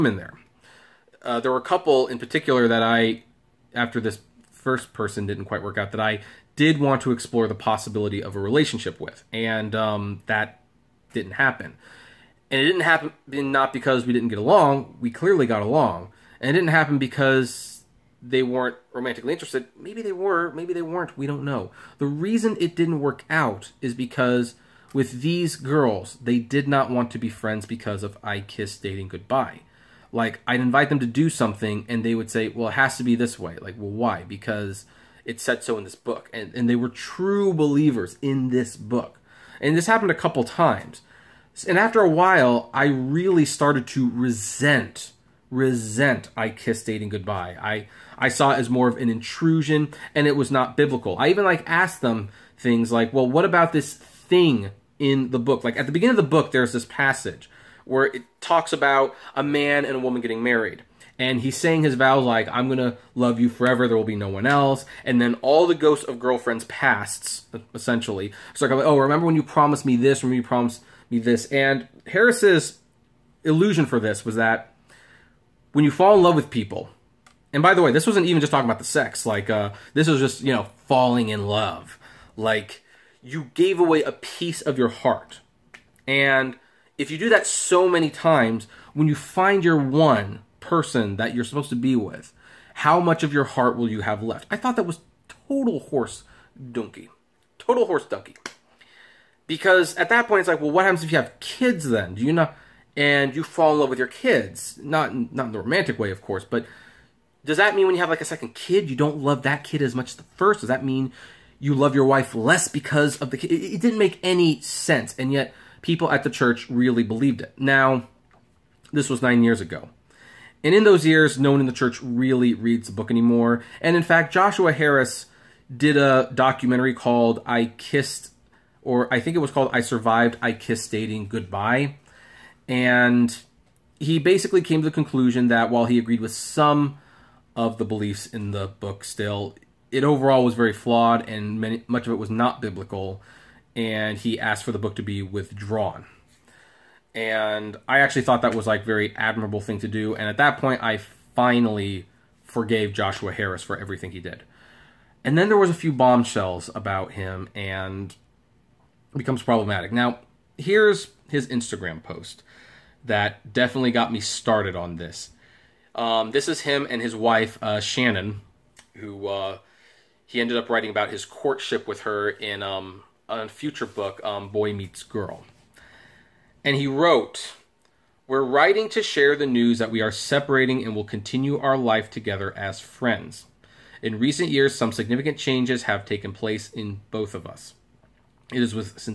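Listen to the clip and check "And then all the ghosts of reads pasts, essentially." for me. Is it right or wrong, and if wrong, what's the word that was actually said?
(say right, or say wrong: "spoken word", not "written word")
wrong: "girlfriends", not "reads".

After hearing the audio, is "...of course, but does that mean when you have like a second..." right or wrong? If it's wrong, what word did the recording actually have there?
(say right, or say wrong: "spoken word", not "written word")
right.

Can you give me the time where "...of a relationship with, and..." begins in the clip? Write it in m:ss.
0:08.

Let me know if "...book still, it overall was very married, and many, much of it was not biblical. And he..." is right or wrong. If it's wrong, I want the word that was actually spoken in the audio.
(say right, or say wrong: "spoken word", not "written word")
wrong: "flawed", not "married".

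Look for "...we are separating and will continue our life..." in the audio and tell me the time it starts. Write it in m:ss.
2:59.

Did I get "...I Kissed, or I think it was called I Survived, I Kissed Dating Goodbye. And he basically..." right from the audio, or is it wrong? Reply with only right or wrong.
right.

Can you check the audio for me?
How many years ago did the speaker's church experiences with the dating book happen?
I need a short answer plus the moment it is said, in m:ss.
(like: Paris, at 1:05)
9, at 1:59.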